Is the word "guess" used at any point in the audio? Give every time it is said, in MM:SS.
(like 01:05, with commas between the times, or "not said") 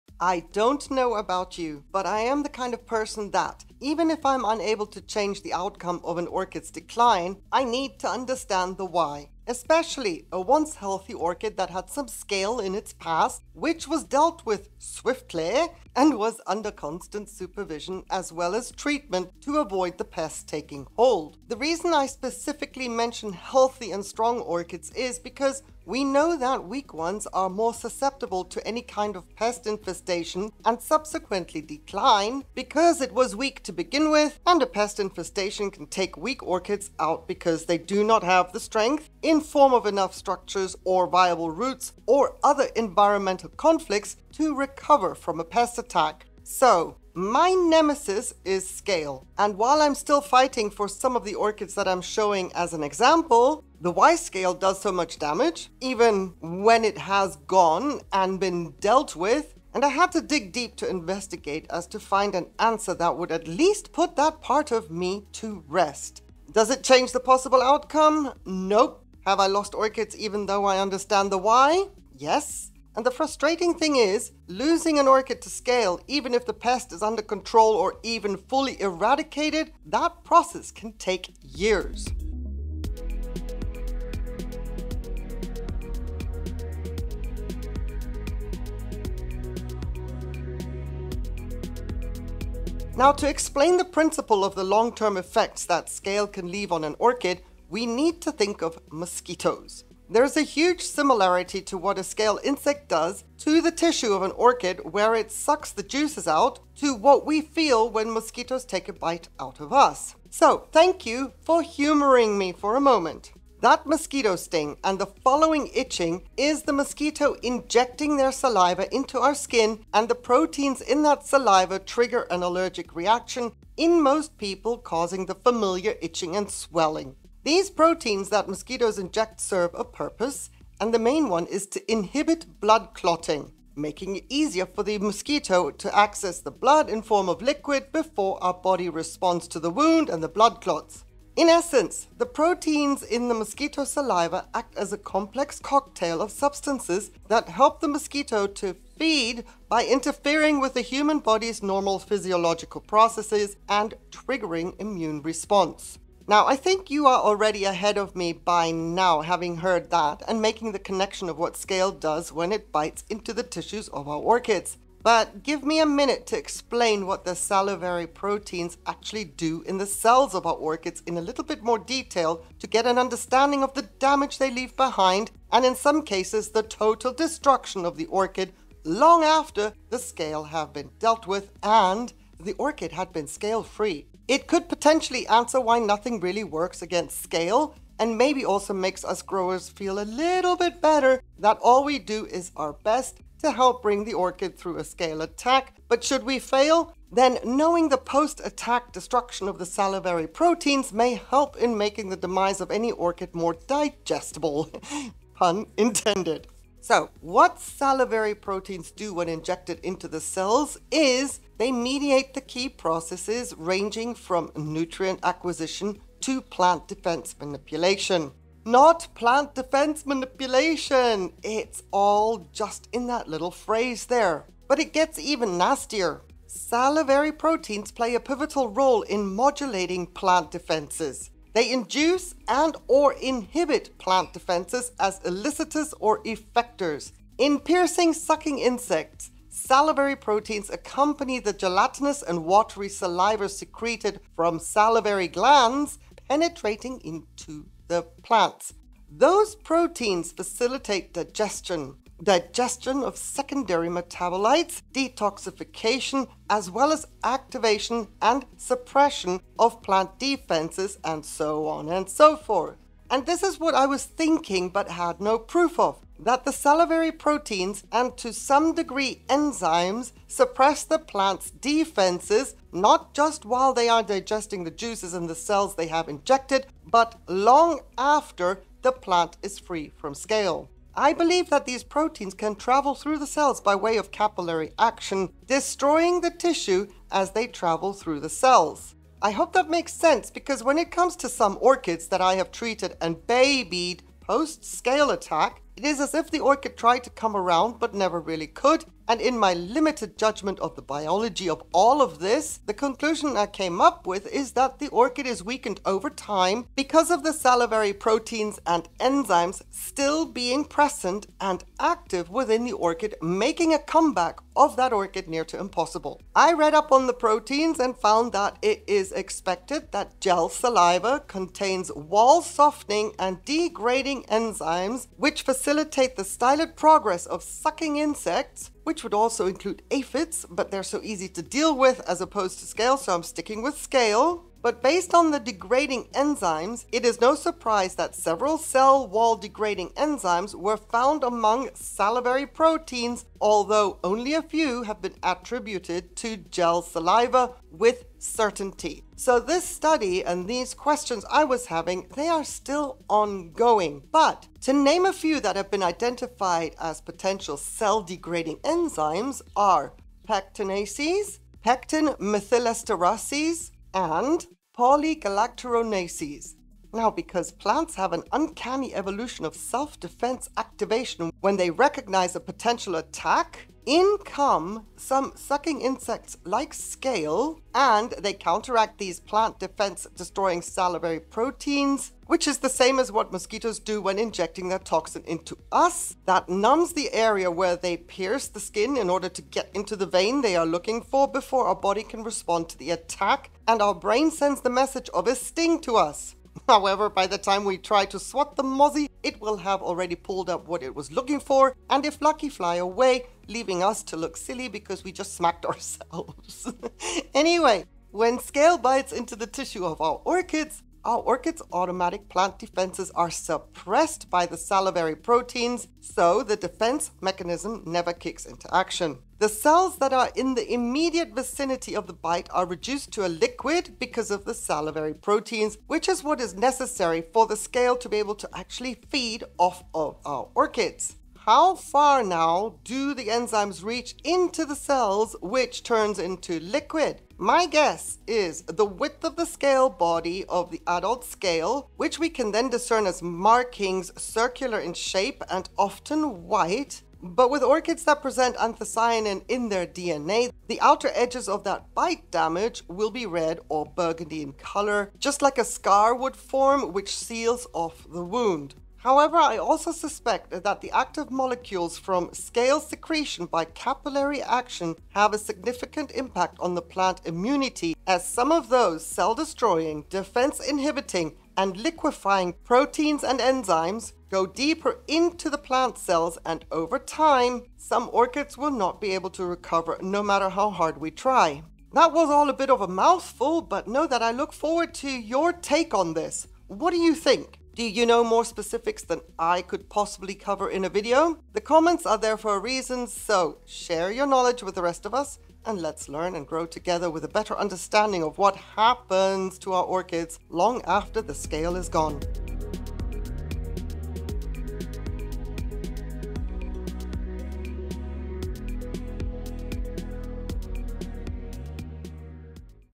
07:17.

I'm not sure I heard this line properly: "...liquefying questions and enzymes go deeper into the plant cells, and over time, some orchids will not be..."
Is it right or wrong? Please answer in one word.
wrong.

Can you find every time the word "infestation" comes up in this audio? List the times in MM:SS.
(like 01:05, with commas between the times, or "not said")
00:29, 00:35.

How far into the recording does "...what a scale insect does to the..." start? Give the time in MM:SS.
01:41.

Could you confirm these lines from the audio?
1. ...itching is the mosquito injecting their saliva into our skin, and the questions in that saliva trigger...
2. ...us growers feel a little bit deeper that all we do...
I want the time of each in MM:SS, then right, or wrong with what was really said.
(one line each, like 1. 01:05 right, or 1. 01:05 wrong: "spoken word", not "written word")
1. 01:55 wrong: "proteins", not "questions"
2. 03:09 wrong: "better", not "deeper".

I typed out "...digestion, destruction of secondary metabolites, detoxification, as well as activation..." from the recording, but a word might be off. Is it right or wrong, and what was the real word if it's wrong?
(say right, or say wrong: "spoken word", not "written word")
wrong: "digestion", not "destruction".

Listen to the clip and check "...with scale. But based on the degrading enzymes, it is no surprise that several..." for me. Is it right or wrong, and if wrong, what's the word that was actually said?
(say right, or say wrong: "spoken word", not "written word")
right.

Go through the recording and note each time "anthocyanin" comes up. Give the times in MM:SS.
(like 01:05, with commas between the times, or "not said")
07:28.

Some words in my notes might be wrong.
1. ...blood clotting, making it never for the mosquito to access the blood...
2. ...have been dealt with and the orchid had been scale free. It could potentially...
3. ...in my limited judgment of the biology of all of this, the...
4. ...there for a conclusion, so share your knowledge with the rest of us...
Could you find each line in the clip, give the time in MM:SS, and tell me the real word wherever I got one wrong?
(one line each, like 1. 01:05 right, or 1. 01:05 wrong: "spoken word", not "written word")
1. 02:12 wrong: "easier", not "never"
2. 03:00 right
3. 04:59 right
4. 08:12 wrong: "reason", not "conclusion".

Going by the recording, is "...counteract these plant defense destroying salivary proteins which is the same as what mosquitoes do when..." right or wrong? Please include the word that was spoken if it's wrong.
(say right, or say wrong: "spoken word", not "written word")
right.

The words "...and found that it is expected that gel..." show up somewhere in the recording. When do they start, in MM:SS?
05:17.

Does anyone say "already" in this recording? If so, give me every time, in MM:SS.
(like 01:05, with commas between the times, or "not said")
02:37, 06:39.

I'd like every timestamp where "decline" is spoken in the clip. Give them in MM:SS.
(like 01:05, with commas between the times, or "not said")
00:06, 00:31.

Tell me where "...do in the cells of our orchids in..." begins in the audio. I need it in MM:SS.
02:49.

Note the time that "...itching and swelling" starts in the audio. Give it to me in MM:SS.
02:06.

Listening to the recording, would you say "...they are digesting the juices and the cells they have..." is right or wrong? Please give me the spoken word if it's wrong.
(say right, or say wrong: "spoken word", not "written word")
right.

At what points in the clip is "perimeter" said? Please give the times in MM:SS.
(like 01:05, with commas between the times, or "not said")
not said.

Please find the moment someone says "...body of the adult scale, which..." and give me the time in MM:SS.
07:19.